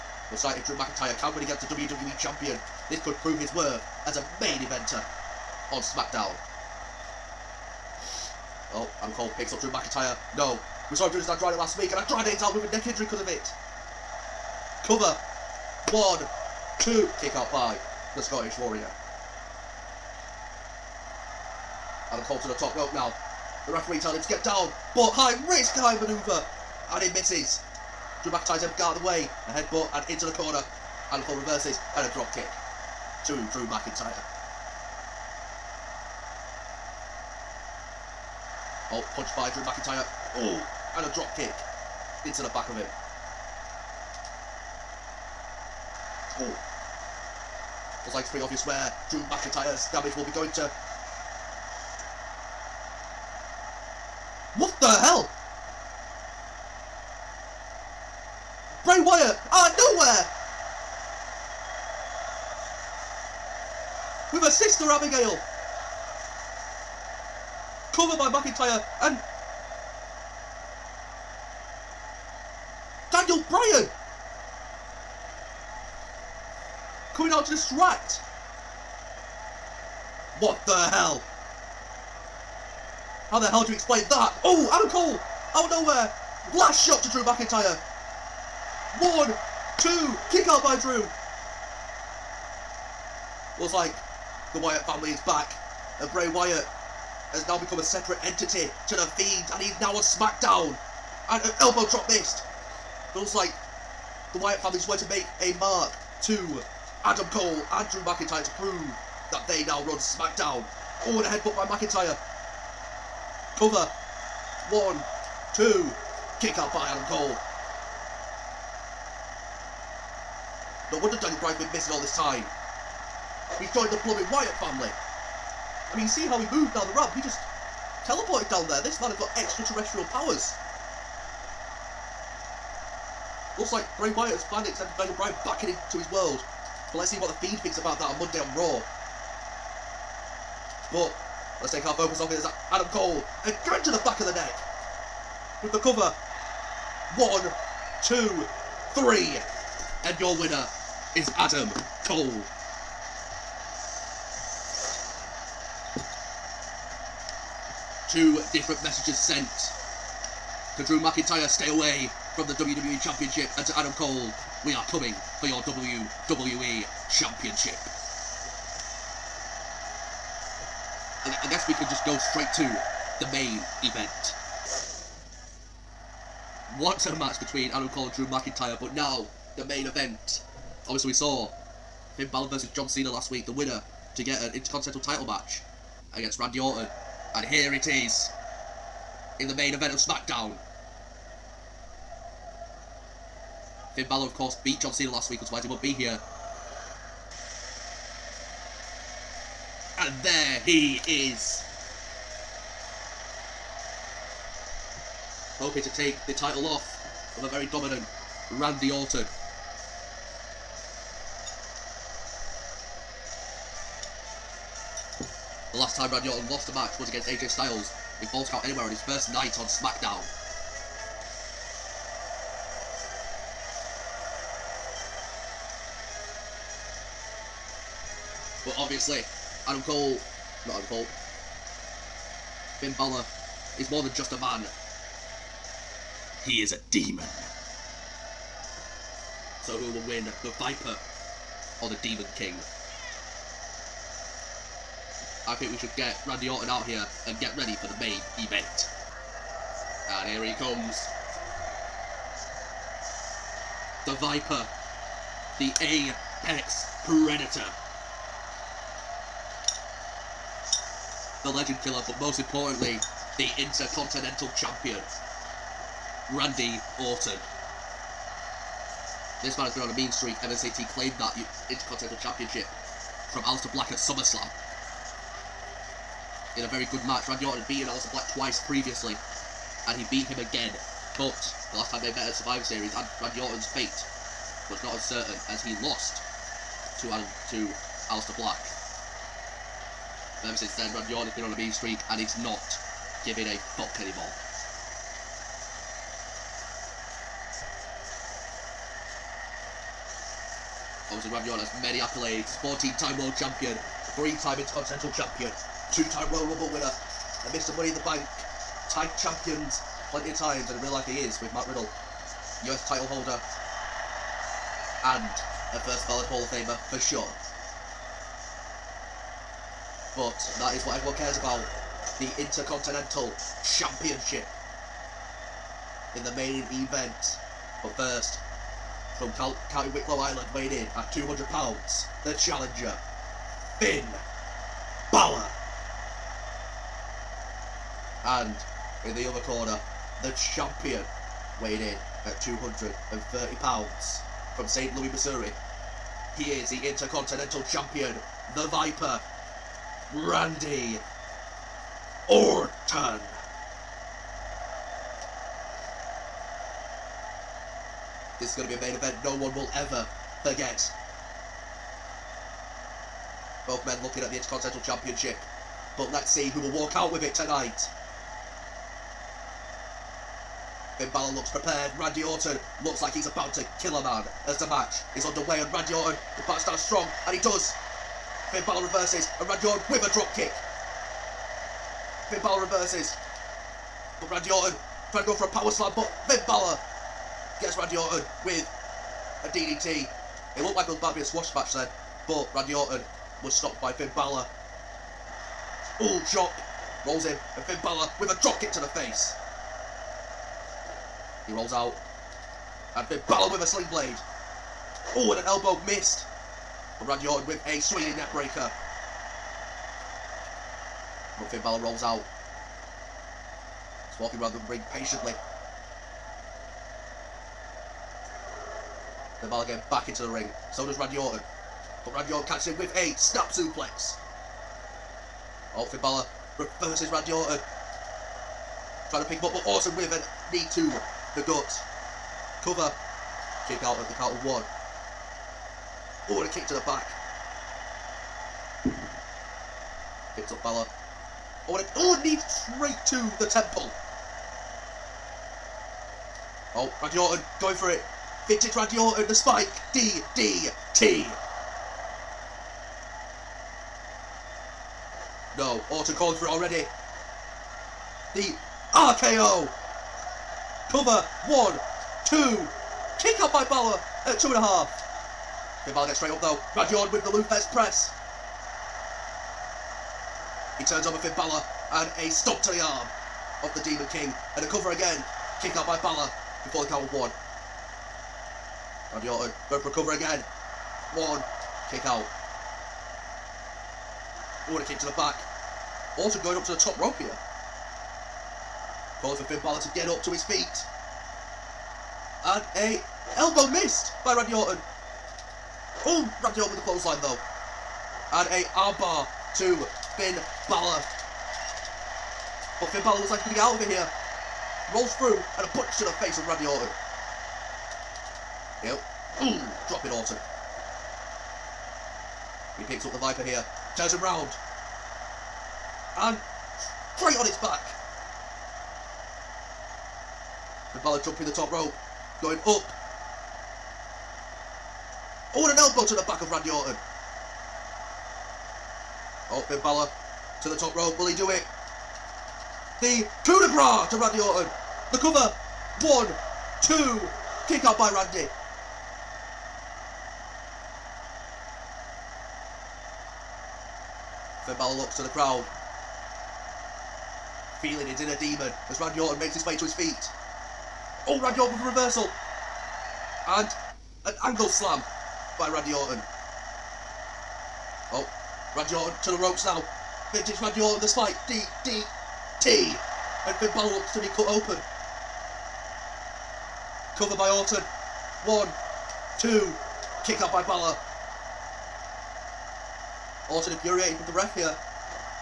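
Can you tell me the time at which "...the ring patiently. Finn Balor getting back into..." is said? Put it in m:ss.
6:54.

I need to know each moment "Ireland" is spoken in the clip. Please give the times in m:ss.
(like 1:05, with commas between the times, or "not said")
5:30.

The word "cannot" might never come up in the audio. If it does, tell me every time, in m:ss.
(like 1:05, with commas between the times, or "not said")
not said.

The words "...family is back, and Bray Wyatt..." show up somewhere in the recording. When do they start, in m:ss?
1:34.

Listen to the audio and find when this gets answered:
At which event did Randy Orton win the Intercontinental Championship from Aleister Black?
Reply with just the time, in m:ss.
4:33.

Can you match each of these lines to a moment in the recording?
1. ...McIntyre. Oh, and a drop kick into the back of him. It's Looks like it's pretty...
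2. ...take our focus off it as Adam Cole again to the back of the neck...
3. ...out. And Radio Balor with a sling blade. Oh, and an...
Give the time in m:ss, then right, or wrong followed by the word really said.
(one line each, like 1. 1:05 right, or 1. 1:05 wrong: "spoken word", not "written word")
1. 0:39 right
2. 2:21 right
3. 6:41 wrong: "Finn", not "Radio".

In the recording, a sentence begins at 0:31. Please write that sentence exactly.
And a full reverses and a drop kick to Drew McIntyre.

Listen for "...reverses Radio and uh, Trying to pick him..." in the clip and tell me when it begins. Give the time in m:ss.
7:06.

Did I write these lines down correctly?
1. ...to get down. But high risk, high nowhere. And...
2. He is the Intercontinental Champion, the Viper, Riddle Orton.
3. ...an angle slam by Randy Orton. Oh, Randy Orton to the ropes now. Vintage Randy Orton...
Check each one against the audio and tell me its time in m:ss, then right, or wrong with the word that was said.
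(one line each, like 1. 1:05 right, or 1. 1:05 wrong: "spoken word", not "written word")
1. 0:24 wrong: "manoeuvre", not "nowhere"
2. 5:46 wrong: "Randy", not "Riddle"
3. 9:14 right.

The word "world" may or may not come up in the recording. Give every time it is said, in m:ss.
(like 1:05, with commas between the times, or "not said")
2:16, 5:03.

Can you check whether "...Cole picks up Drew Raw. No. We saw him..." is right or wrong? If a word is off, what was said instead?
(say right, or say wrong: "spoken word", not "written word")
wrong: "McIntyre", not "Raw".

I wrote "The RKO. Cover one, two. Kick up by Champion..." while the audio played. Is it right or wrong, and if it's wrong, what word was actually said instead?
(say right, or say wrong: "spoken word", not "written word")
wrong: "Balor", not "Champion".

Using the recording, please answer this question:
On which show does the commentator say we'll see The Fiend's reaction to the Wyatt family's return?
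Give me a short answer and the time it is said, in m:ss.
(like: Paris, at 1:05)
Raw, at 2:18.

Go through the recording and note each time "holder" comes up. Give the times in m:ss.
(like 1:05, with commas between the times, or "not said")
5:13.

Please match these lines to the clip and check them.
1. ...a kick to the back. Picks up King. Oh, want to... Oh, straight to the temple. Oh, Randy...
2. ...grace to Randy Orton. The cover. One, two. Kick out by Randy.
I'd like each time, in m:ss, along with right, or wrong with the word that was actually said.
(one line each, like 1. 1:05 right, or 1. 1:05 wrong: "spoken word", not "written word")
1. 7:16 wrong: "Balor", not "King"
2. 8:53 right.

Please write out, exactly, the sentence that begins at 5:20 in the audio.
but that is what everyone cares about.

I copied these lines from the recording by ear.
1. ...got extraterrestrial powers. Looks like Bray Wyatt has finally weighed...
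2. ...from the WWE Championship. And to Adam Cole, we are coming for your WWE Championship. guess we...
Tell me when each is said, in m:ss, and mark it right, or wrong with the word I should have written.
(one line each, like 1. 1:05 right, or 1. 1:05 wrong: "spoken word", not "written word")
1. 2:09 wrong: "extended", not "weighed"
2. 2:42 right.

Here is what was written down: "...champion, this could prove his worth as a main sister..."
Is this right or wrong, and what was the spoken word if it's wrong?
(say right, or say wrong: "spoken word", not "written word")
wrong: "eventer", not "sister".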